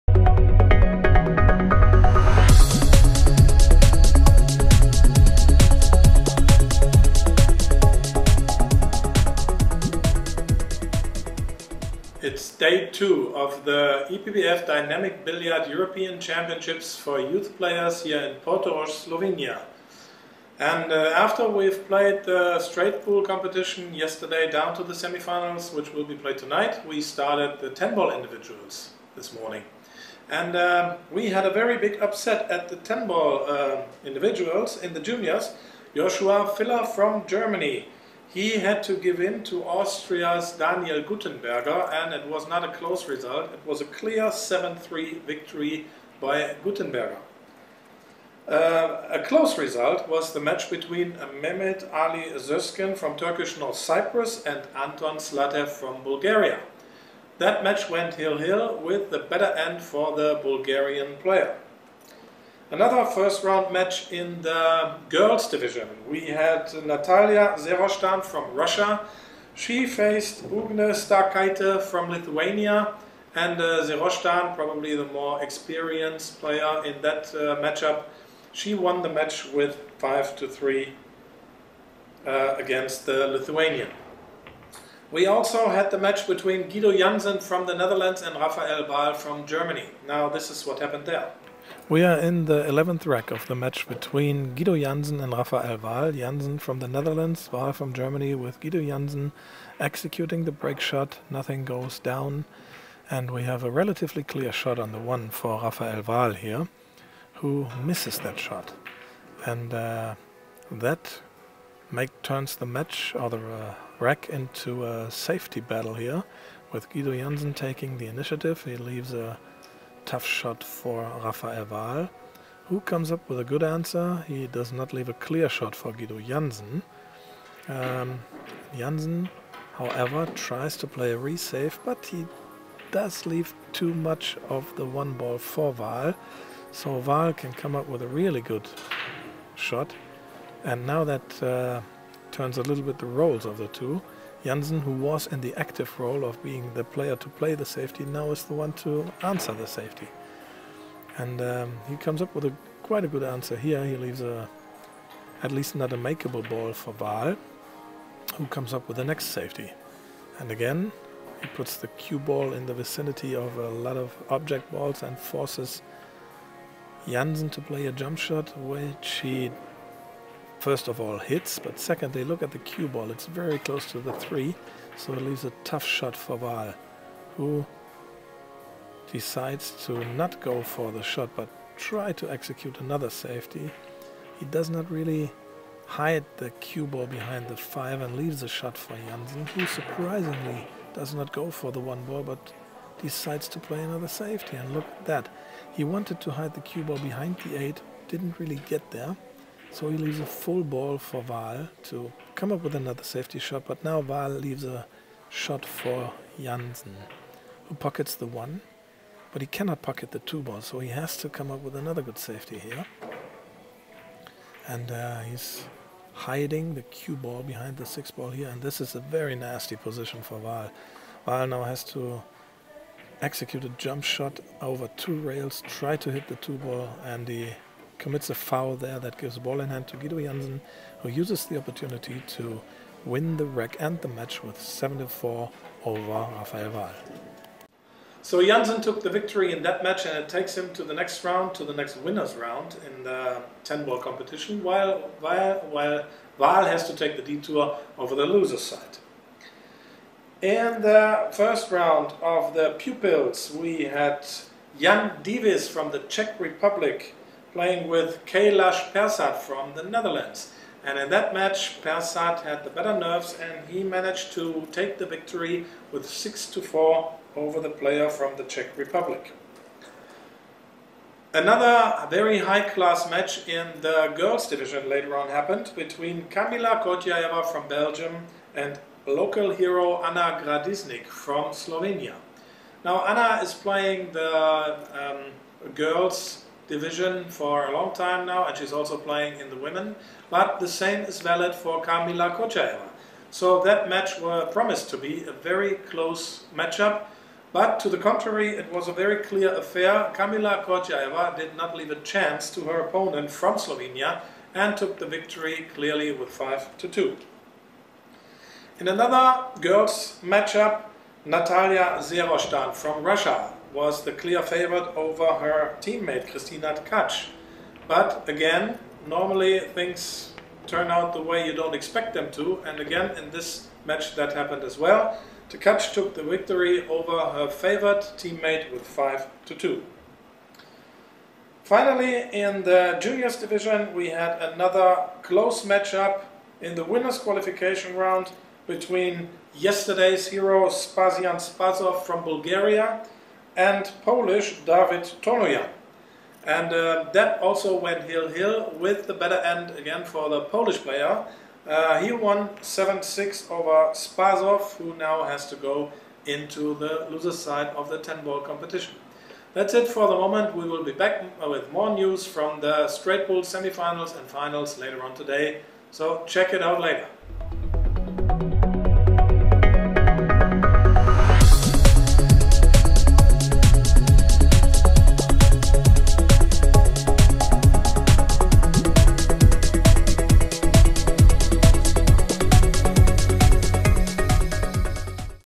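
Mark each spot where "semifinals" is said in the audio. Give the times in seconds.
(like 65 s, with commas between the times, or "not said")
24 s, 363 s.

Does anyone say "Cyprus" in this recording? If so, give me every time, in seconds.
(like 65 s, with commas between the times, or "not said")
53 s.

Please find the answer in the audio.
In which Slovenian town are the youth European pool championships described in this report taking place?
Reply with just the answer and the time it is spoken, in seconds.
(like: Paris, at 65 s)
Portorož, at 18 s.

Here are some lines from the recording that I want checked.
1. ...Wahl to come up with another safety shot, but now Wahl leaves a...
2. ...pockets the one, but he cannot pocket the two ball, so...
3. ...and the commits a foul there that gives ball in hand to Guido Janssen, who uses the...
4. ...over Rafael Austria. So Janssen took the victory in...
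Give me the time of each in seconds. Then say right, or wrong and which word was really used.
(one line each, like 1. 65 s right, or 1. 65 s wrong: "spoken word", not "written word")
1. 201 s right
2. 207 s right
3. 227 s right
4. 235 s wrong: "Wahl", not "Austria".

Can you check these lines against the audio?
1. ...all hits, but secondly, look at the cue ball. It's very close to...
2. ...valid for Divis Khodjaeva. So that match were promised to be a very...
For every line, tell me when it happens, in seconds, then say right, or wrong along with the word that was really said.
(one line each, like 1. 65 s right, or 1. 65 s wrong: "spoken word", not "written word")
1. 171 s right
2. 291 s wrong: "Kamila", not "Divis".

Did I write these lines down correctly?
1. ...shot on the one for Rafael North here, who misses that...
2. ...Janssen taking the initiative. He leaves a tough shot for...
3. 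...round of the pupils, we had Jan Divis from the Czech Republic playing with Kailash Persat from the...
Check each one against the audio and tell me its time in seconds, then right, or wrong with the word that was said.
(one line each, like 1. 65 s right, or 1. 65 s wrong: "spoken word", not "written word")
1. 104 s wrong: "Wahl", not "North"
2. 117 s right
3. 251 s right.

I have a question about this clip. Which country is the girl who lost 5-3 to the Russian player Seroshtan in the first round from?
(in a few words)
Lithuania.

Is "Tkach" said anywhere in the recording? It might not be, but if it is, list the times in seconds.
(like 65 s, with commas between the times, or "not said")
316 s, 325 s.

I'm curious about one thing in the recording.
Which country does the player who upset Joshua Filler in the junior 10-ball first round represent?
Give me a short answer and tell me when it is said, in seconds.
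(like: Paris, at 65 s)
Austria, at 39 s.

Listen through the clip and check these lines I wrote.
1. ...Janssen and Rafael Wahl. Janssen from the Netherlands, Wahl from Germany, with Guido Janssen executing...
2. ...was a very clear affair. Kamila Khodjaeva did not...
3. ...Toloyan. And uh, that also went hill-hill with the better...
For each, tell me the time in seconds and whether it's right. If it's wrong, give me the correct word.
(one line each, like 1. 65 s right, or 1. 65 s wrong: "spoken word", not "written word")
1. 94 s right
2. 298 s right
3. 345 s right.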